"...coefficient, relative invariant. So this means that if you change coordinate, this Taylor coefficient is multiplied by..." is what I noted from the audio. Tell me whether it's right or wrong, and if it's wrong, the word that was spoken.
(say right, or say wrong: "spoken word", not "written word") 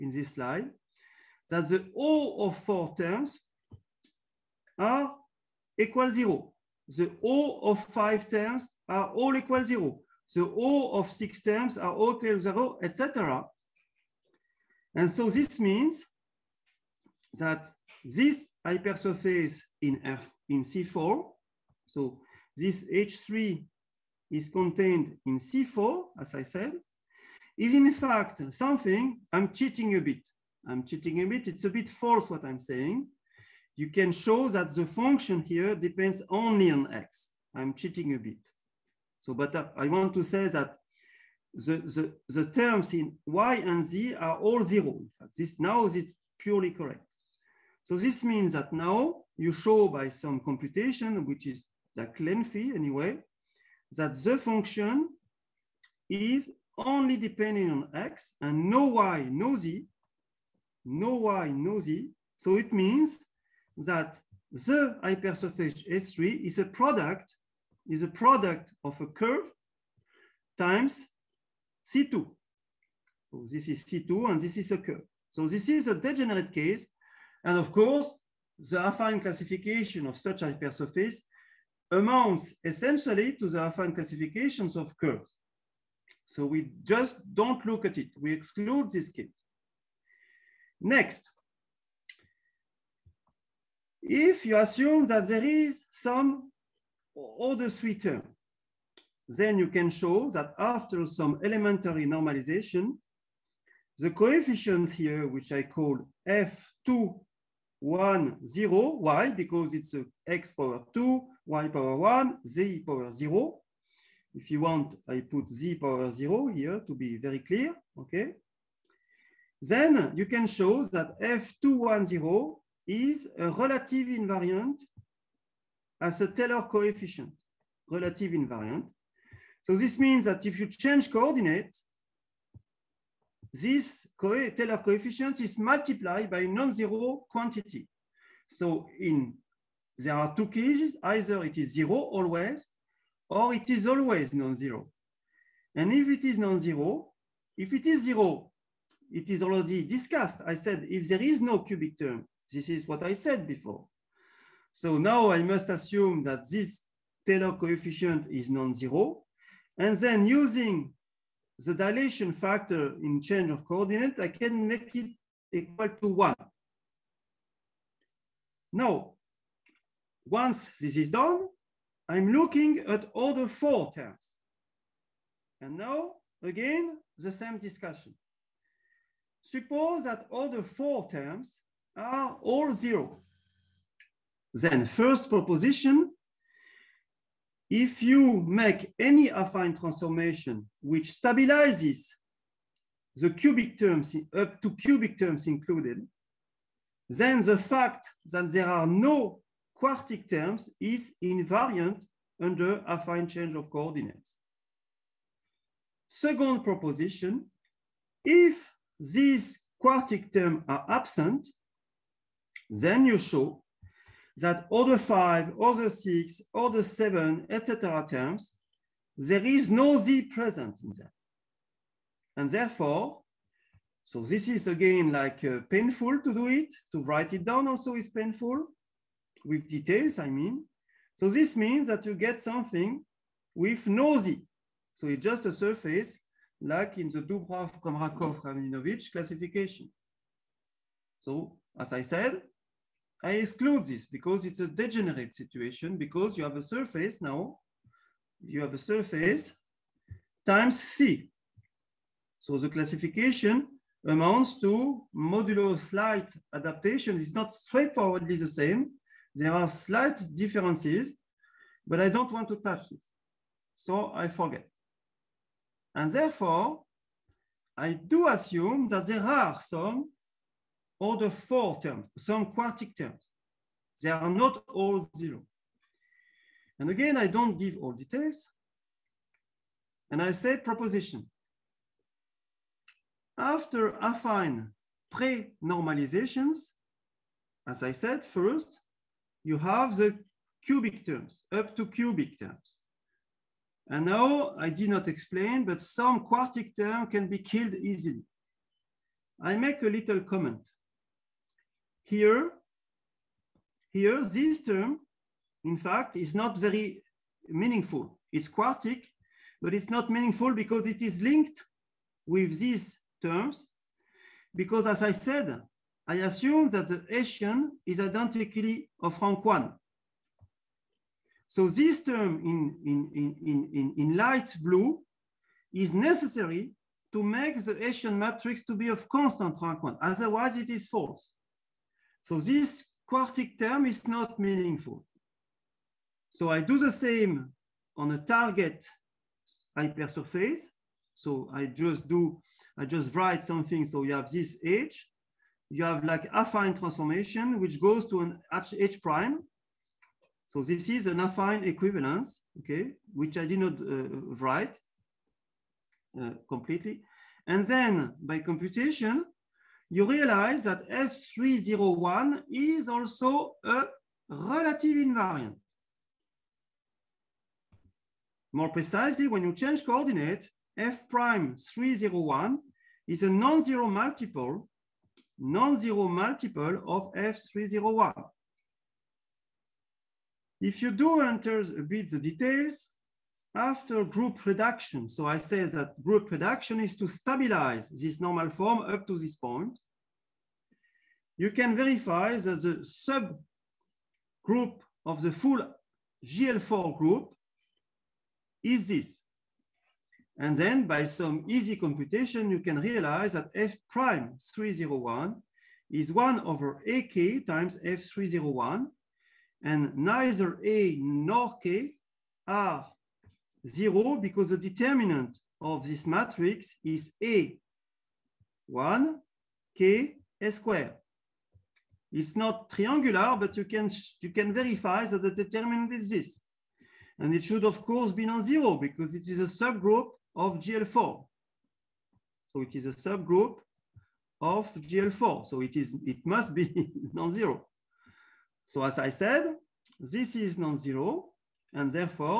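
right.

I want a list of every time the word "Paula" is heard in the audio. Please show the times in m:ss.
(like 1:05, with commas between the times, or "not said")
not said.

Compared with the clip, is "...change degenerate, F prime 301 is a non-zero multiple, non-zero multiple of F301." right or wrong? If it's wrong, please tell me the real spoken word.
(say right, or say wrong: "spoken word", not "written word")
wrong: "coordinate", not "degenerate".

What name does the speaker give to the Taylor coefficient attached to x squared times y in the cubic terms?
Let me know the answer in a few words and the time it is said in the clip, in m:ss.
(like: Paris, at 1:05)
F210, at 1:46.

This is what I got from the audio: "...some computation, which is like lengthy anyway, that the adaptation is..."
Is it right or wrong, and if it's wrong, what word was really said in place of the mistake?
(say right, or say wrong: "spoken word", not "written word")
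wrong: "function", not "adaptation".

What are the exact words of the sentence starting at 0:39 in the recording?
So, but I want to say that the, the, the terms in y and z are all zero.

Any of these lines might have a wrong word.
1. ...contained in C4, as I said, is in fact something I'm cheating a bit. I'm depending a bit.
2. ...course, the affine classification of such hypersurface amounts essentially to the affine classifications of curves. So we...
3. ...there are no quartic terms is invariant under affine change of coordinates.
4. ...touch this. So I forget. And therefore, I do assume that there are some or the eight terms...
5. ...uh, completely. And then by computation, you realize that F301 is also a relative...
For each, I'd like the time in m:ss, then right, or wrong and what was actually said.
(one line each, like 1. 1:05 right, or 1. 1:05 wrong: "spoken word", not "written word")
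1. 0:24 wrong: "cheating", not "depending"
2. 1:17 right
3. 3:18 right
4. 4:22 wrong: "four", not "eight"
5. 5:56 right.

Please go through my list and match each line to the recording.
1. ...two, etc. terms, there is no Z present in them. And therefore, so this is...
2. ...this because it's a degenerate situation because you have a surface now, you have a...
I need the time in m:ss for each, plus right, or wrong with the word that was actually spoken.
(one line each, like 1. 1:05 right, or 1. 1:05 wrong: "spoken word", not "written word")
1. 3:36 wrong: "seven", not "two"
2. 4:03 right.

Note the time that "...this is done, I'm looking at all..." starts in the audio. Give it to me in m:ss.
2:50.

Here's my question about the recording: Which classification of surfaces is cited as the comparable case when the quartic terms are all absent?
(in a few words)
Doubrov-Komrakov-Rabinovich.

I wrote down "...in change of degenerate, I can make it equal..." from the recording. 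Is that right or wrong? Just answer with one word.
wrong.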